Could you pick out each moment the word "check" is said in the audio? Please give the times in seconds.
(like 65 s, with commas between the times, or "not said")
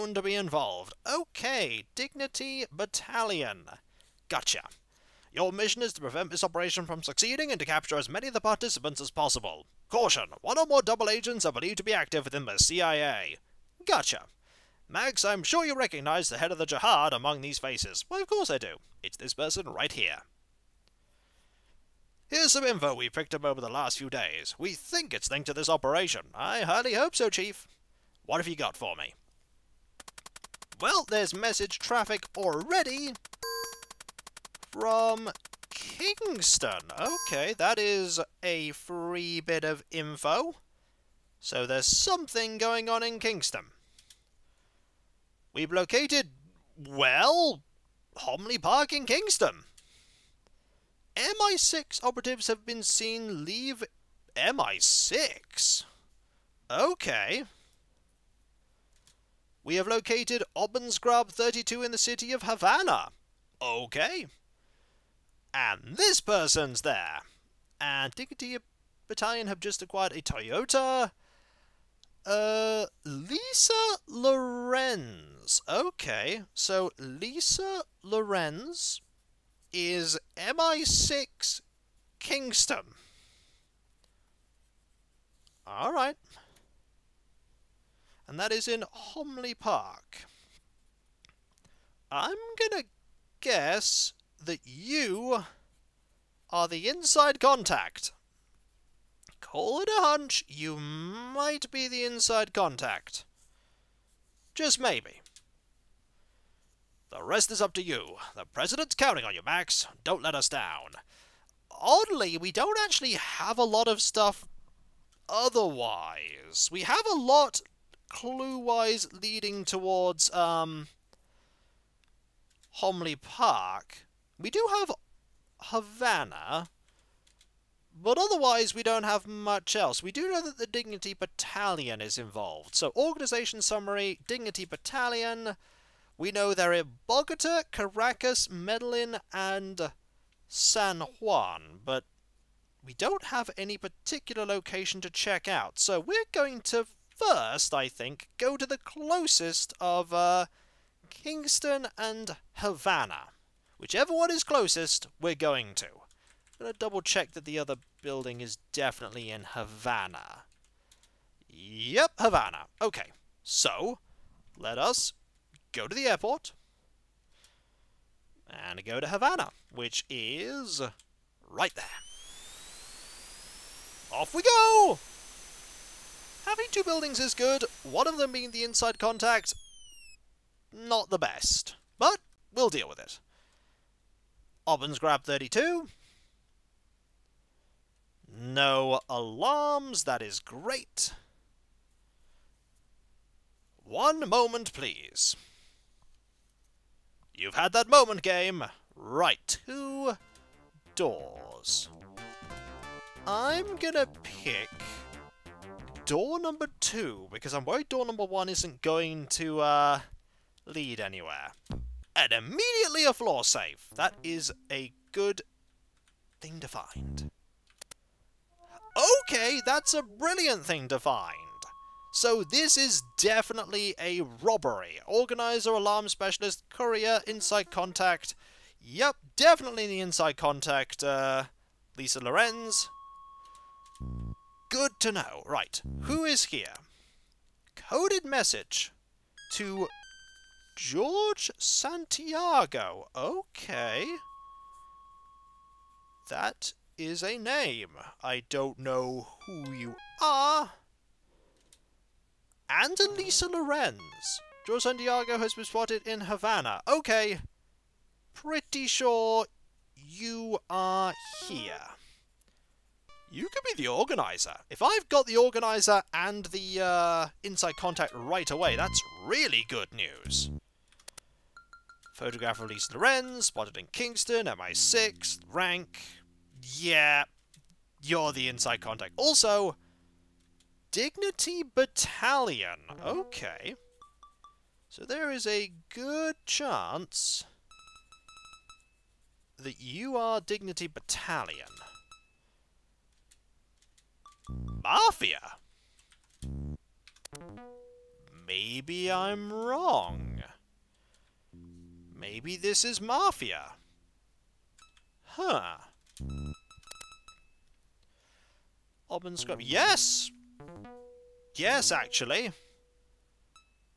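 145 s, 157 s.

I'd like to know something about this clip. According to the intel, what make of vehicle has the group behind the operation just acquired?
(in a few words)
Toyota.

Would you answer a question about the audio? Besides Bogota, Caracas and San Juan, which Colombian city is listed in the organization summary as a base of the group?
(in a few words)
Medellin.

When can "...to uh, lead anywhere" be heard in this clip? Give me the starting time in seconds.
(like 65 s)
209 s.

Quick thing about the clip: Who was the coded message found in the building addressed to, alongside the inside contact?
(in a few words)
George Santiago.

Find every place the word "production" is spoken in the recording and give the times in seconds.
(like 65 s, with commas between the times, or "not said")
not said.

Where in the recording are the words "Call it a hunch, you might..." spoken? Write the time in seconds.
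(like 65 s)
99 s.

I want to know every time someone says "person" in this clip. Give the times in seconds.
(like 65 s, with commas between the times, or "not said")
19 s, 66 s.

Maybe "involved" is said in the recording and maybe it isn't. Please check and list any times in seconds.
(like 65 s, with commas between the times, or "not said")
0 s, 132 s.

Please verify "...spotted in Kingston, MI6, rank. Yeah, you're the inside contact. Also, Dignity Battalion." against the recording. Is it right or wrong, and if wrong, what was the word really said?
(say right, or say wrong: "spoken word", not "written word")
right.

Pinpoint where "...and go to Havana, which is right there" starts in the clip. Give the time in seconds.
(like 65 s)
168 s.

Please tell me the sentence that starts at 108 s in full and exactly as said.
The President's counting on you, Max.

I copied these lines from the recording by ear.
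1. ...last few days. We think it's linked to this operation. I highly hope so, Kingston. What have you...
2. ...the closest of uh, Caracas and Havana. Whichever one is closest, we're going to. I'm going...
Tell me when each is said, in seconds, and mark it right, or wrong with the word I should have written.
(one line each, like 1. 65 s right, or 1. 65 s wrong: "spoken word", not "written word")
1. 23 s wrong: "Chief", not "Kingston"
2. 148 s wrong: "Kingston", not "Caracas".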